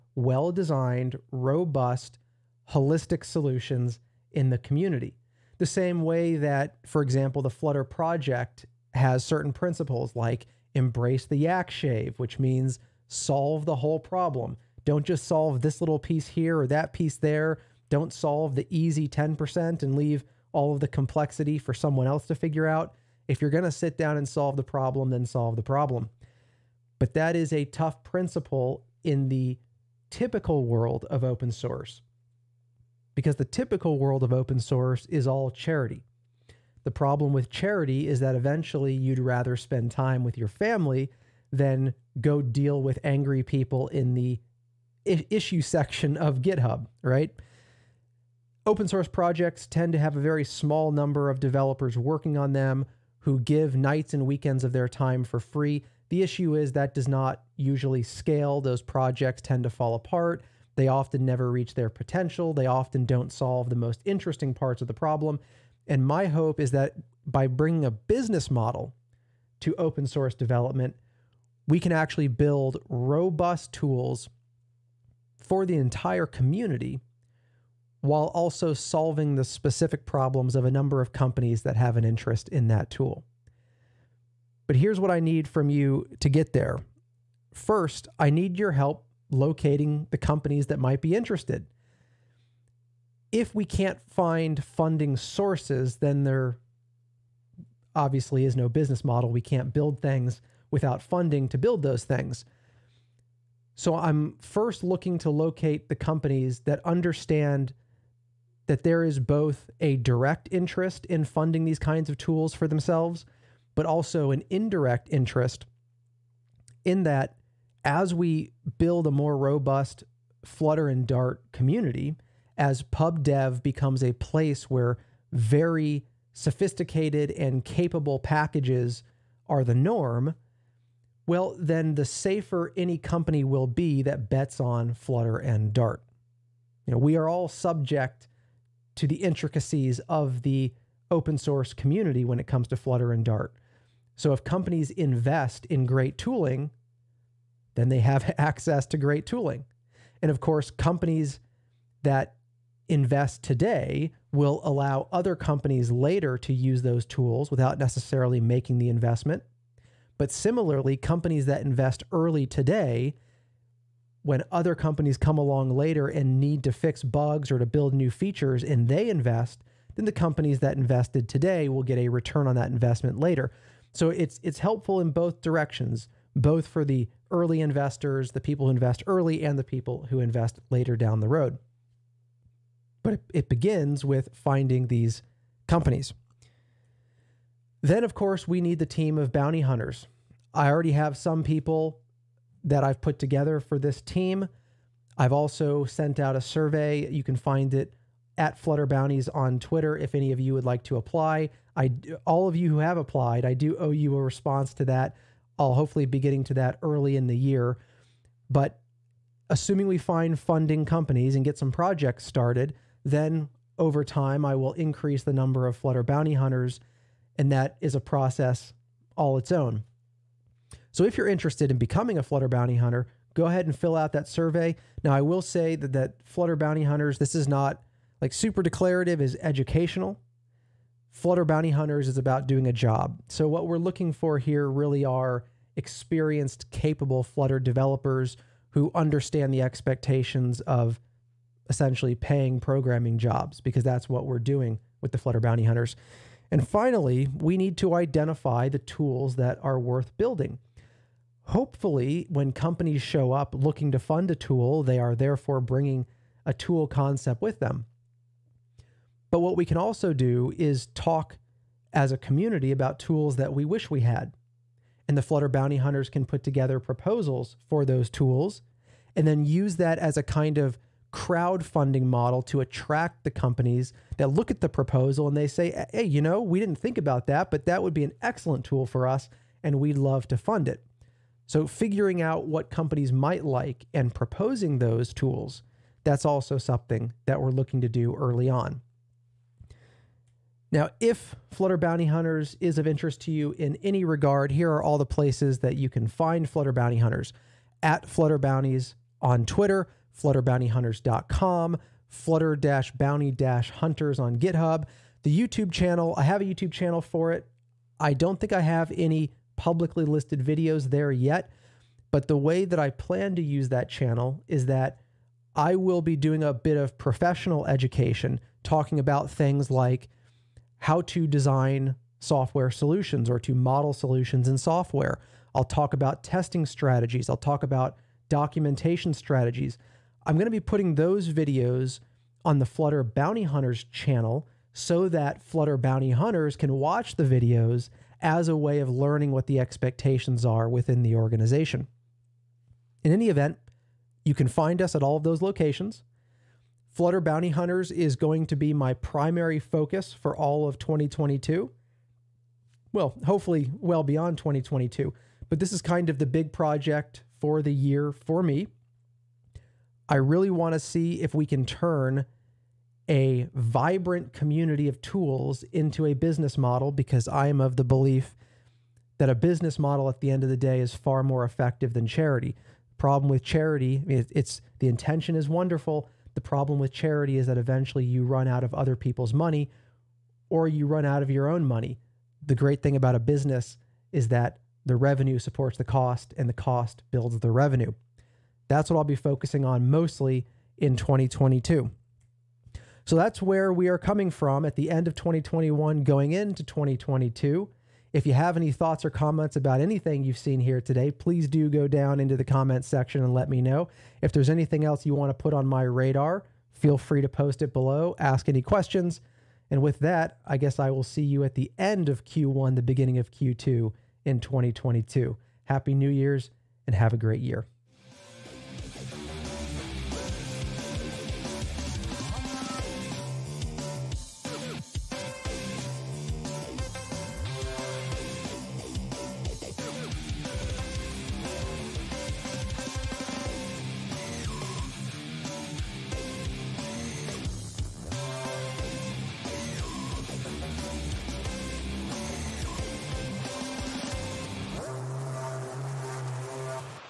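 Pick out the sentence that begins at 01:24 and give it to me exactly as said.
But here's what I need from you to get there.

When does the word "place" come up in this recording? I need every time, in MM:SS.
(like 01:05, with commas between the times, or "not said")
02:04, 04:55.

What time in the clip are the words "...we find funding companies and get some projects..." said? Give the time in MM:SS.
03:29.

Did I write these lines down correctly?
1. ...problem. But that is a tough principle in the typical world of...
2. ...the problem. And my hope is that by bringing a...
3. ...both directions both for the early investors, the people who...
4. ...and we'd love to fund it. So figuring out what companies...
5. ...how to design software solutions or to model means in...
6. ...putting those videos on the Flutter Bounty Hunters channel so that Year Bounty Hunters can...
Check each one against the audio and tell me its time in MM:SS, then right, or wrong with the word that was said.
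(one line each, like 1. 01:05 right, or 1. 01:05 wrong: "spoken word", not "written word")
1. 00:25 right
2. 01:04 right
3. 02:55 right
4. 04:39 right
5. 05:20 wrong: "solutions", not "means"
6. 05:30 wrong: "Flutter", not "Year".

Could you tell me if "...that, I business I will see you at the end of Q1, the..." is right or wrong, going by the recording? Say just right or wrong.
wrong.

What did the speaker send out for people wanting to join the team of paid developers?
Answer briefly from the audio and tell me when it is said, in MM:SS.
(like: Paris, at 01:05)
a survey, at 03:16.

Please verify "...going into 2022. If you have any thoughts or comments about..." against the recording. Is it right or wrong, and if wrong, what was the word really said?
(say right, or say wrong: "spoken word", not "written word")
right.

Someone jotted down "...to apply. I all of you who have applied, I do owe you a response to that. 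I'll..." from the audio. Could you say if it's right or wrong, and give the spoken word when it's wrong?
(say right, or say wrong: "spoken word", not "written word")
right.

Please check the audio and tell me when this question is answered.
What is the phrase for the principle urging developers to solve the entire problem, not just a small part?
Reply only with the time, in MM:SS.
00:10.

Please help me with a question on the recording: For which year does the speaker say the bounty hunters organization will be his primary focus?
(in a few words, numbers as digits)
2022.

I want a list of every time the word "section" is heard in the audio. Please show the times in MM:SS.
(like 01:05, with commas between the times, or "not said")
00:45, 06:42.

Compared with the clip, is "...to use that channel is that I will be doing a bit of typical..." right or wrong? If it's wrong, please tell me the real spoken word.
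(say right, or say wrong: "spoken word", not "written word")
wrong: "professional", not "typical".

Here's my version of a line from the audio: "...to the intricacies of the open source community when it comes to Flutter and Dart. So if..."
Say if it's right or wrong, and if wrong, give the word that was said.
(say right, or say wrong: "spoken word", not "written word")
right.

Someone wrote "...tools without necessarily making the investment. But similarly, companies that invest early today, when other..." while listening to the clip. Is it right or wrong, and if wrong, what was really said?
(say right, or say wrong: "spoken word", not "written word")
right.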